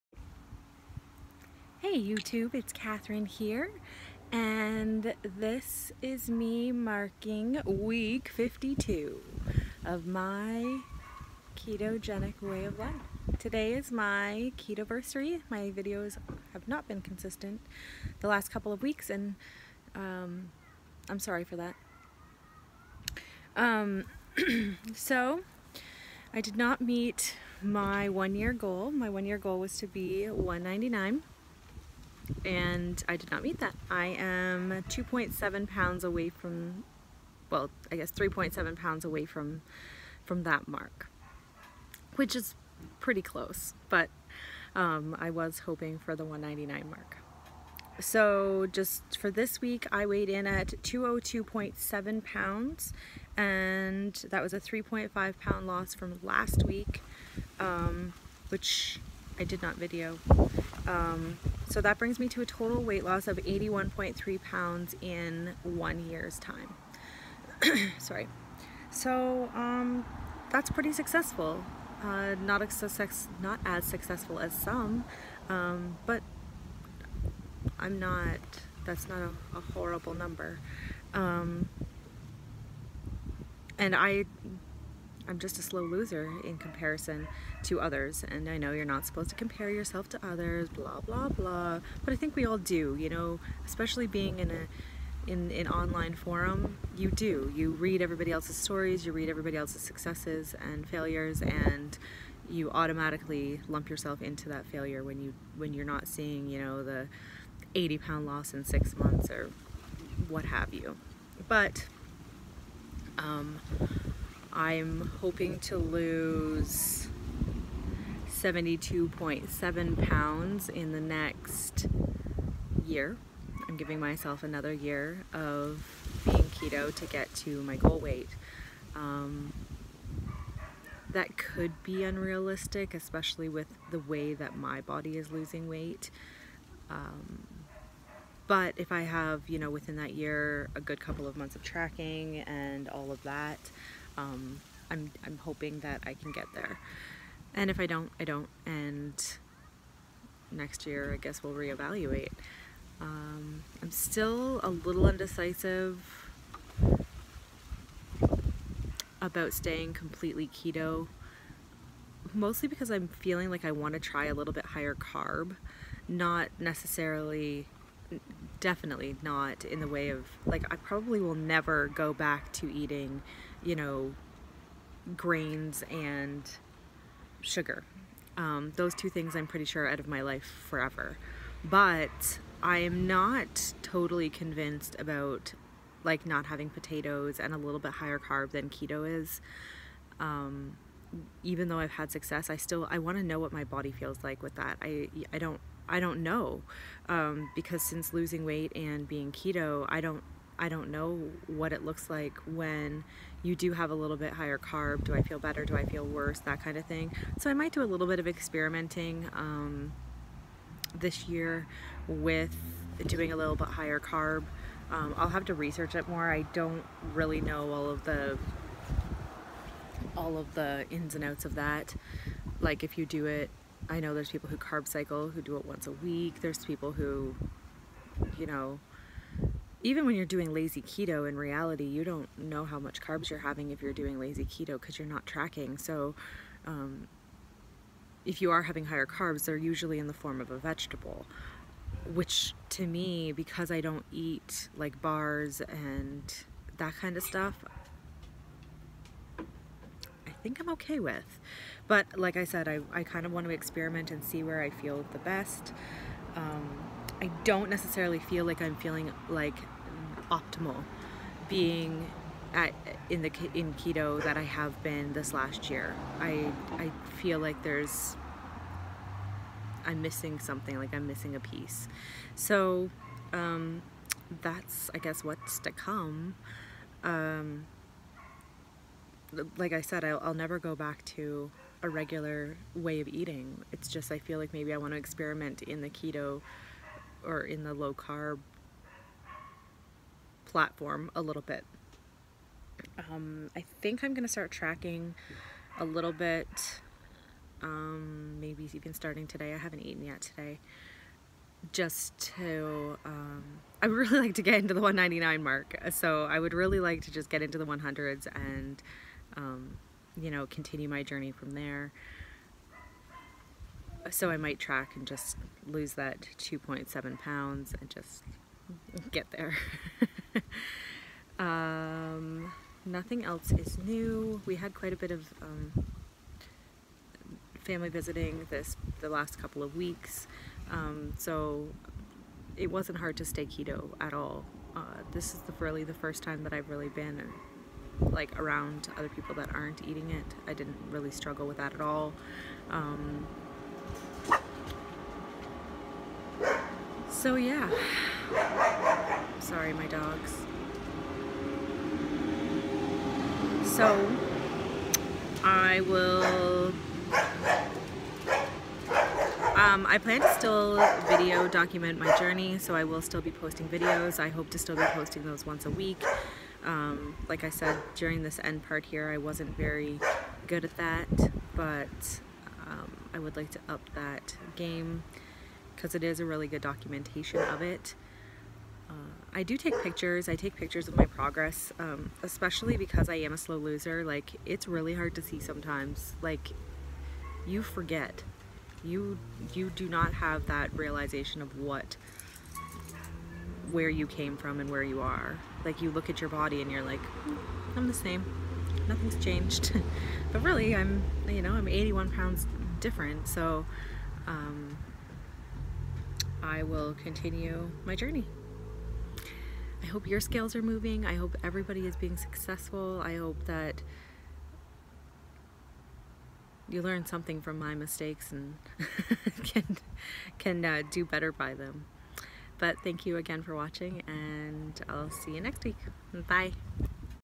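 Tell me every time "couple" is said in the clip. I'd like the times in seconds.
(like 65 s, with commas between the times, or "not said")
18 s, 140 s, 329 s.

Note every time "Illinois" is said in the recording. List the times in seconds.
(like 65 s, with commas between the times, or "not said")
not said.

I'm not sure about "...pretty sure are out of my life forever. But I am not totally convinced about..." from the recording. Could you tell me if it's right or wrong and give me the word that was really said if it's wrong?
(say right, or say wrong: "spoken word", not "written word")
right.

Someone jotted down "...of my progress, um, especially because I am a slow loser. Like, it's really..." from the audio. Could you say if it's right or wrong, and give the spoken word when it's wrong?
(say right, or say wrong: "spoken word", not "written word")
right.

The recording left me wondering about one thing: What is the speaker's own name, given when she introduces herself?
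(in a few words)
Catherine.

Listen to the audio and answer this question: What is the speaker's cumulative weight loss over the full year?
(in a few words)
81.3 pounds.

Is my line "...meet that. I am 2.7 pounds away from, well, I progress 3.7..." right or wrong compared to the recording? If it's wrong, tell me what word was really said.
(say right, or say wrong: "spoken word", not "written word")
wrong: "guess", not "progress".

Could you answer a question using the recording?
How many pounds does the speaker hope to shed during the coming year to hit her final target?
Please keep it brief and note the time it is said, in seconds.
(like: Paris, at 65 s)
72.7 pounds, at 118 s.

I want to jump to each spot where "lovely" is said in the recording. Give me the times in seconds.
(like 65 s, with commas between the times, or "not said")
not said.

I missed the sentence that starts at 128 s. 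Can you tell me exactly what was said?
Um, that could be unrealistic, especially with the way that my body is losing weight.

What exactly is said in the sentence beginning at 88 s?
And I know you're not supposed to compare yourself to others, blah, blah, blah.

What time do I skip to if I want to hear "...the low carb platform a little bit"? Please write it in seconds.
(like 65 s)
287 s.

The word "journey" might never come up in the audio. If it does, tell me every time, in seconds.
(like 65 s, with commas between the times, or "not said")
311 s, 362 s, 407 s.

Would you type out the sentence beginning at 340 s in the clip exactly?
I didn't really struggle with that at all.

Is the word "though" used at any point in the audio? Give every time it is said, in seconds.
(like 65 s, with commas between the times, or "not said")
191 s.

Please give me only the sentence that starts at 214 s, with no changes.
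Um, I'll have to research it more.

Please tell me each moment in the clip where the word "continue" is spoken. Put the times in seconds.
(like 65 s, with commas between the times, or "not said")
310 s, 407 s.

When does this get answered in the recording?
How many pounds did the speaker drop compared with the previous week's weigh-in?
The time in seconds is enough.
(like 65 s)
54 s.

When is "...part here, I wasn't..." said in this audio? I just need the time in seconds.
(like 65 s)
368 s.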